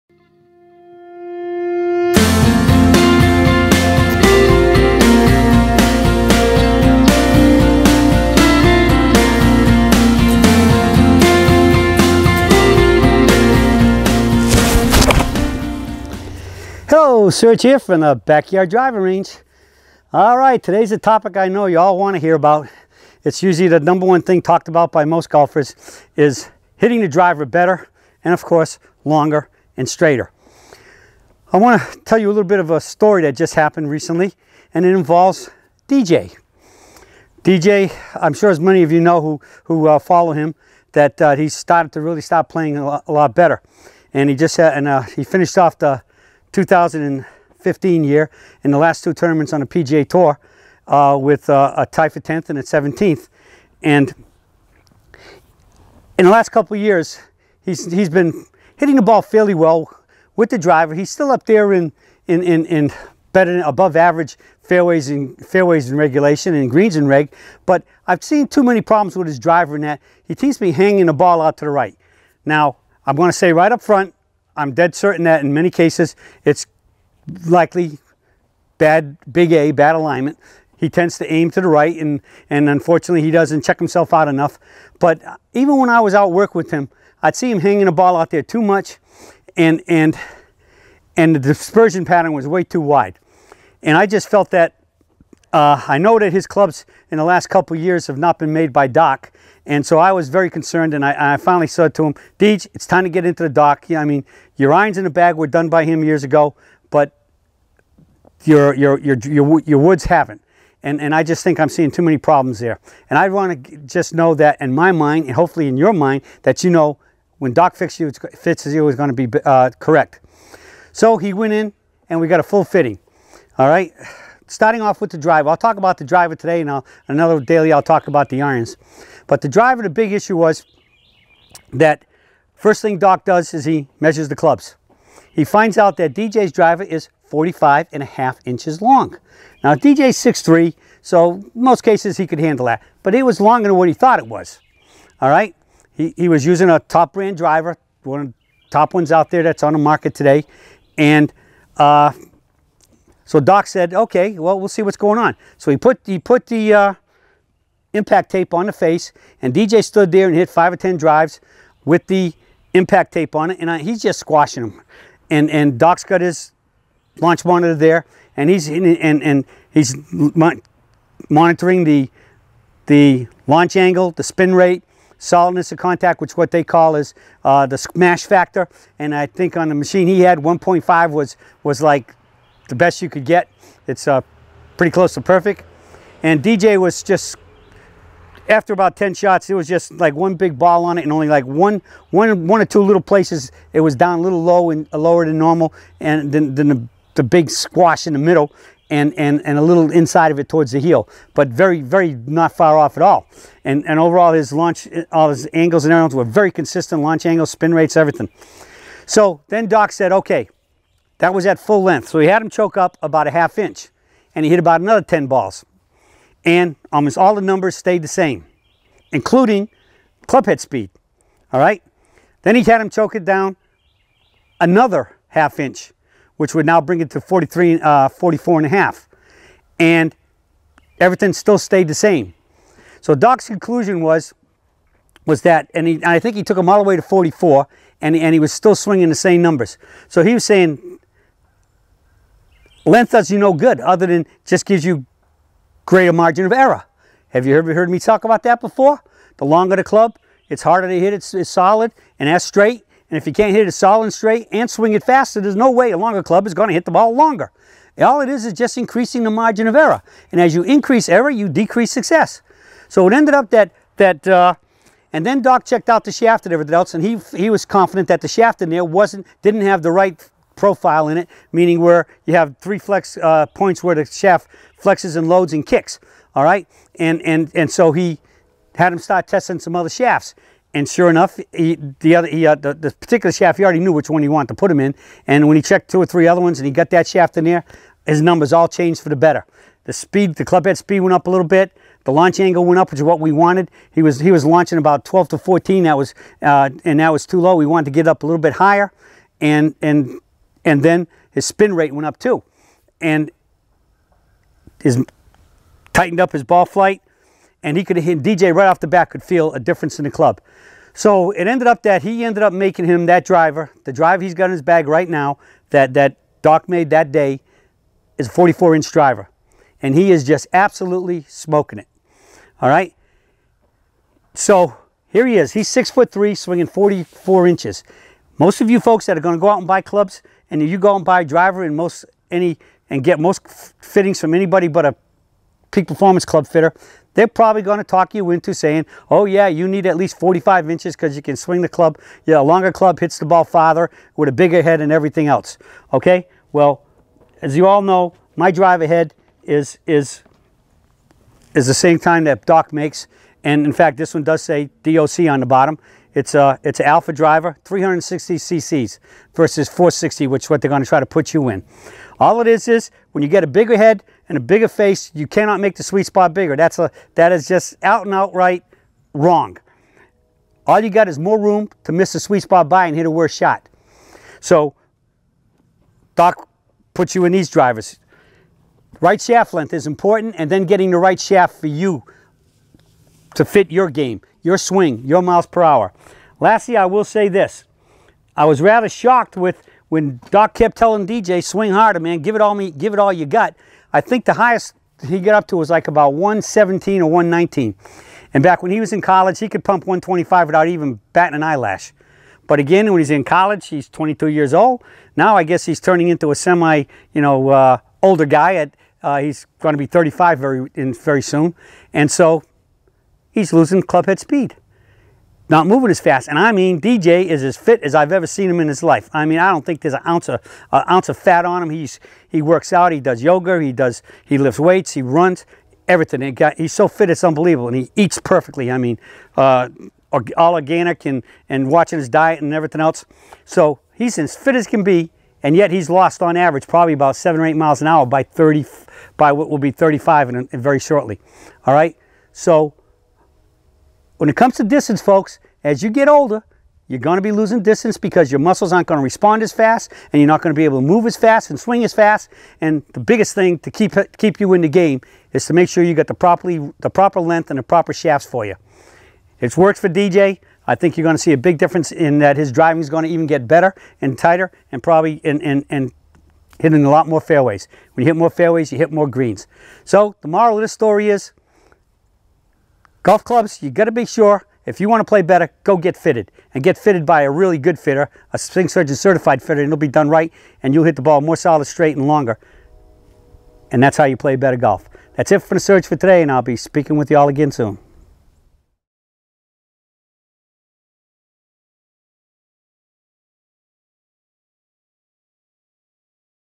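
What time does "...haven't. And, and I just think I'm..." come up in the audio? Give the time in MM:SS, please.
01:50.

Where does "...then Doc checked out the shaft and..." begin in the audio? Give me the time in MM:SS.
04:25.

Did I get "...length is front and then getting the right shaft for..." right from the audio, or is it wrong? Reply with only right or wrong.
wrong.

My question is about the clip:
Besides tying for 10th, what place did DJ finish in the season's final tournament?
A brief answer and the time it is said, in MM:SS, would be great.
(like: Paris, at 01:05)
17th, at 00:52.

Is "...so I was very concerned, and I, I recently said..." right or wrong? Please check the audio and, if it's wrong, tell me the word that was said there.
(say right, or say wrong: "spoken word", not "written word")
wrong: "finally", not "recently".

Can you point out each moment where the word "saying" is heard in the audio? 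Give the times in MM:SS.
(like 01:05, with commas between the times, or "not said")
04:00, 05:38.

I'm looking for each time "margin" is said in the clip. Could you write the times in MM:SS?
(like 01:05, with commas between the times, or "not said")
04:06, 04:19.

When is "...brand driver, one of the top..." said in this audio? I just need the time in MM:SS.
02:27.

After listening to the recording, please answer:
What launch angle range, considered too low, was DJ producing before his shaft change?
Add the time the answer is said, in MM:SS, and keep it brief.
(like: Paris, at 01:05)
12 to 14, at 04:55.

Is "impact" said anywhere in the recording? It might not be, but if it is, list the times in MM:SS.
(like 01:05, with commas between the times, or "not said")
02:37, 02:42.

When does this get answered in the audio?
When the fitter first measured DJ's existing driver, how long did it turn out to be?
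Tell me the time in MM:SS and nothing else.
02:17.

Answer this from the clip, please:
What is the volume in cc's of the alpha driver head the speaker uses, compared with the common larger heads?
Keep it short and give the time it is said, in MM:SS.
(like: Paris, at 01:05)
360 cc, at 05:57.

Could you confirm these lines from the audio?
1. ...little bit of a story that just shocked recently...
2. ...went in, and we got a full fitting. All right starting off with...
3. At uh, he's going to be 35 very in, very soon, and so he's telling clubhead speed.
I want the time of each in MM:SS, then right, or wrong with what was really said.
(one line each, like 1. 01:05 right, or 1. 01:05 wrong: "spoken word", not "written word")
1. 00:32 wrong: "happened", not "shocked"
2. 02:01 right
3. 06:48 wrong: "losing", not "telling".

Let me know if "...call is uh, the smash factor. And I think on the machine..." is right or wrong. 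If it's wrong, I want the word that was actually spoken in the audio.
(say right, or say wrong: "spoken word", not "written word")
right.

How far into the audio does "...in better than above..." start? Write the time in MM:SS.
01:02.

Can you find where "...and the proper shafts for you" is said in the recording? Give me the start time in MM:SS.
07:37.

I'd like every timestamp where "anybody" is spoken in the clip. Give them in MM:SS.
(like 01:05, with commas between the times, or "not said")
05:34.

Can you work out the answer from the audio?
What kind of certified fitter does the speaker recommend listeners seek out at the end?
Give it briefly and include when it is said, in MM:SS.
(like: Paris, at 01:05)
swing surgeon certified fitter, at 07:58.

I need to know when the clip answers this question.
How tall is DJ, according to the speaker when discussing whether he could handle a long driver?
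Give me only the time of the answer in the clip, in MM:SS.
02:20.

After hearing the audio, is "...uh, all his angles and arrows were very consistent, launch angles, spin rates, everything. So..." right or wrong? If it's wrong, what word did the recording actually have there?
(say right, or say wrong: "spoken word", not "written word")
right.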